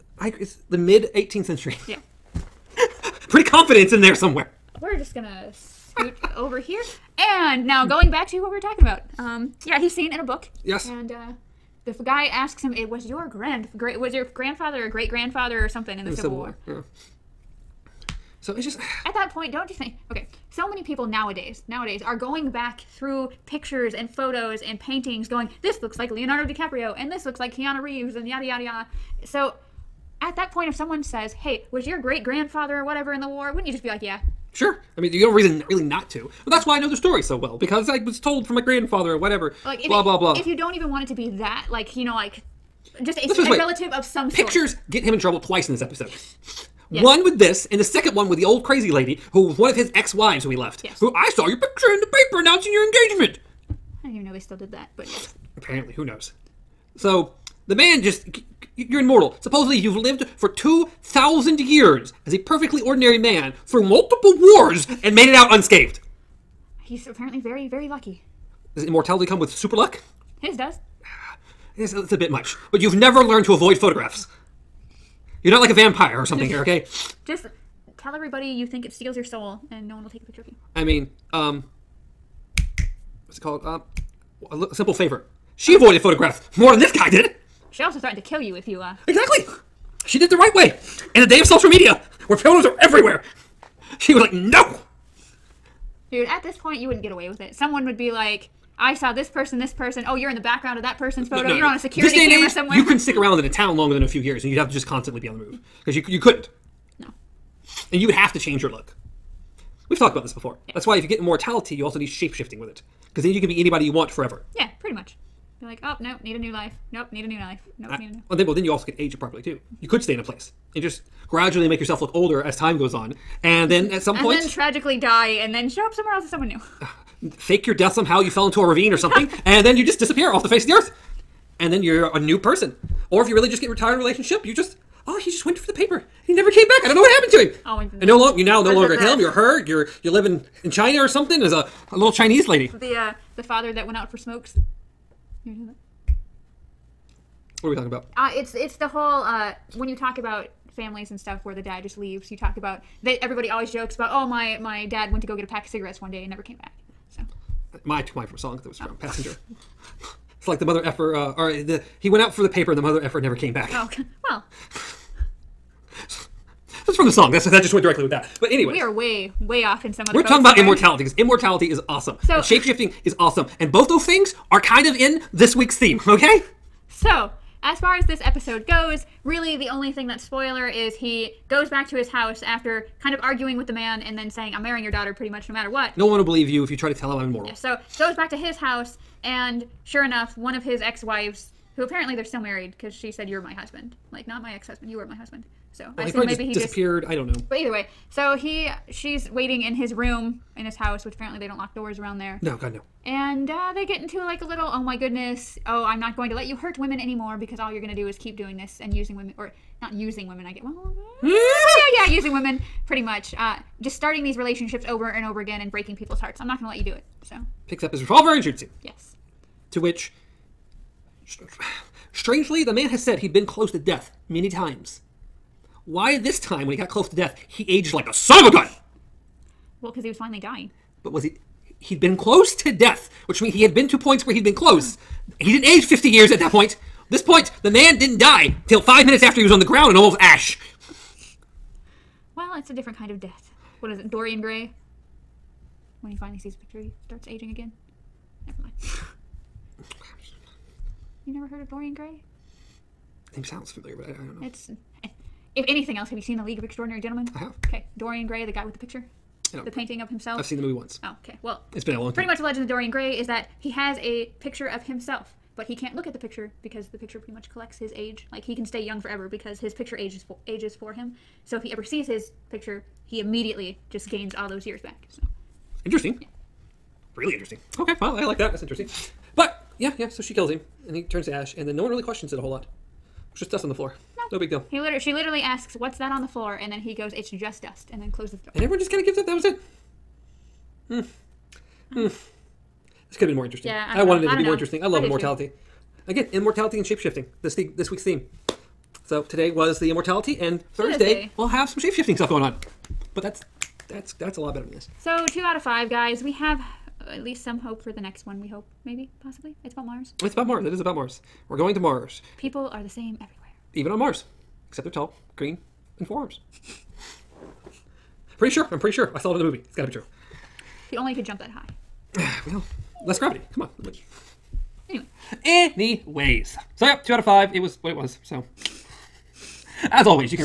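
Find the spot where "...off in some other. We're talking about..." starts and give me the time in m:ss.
2:49.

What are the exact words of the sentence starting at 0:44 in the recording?
get him in trouble twice in this episode.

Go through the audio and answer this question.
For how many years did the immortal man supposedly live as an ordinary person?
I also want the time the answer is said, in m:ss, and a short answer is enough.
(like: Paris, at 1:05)
2,000, at 1:00.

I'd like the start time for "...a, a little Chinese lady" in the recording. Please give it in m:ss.
2:21.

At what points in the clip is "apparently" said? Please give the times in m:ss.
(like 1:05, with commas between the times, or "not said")
0:55, 1:07, 3:11, 3:21.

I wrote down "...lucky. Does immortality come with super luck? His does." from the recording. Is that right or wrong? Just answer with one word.
right.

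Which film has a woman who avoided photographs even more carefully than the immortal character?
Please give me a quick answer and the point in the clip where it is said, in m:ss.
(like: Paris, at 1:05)
A Simple Favor, at 1:24.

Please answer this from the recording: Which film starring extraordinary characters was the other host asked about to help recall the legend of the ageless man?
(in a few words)
The League of Extraordinary Gentlemen.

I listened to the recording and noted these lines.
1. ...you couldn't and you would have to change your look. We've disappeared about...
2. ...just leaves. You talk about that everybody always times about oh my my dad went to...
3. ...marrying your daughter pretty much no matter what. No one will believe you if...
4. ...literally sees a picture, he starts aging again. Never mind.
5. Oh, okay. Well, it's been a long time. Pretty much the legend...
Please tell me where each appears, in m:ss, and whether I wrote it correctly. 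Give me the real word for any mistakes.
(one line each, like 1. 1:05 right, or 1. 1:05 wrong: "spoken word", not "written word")
1. 1:46 wrong: "talked", not "disappeared"
2. 2:31 wrong: "jokes", not "times"
3. 3:04 right
4. 4:06 wrong: "finally", not "literally"
5. 4:21 right.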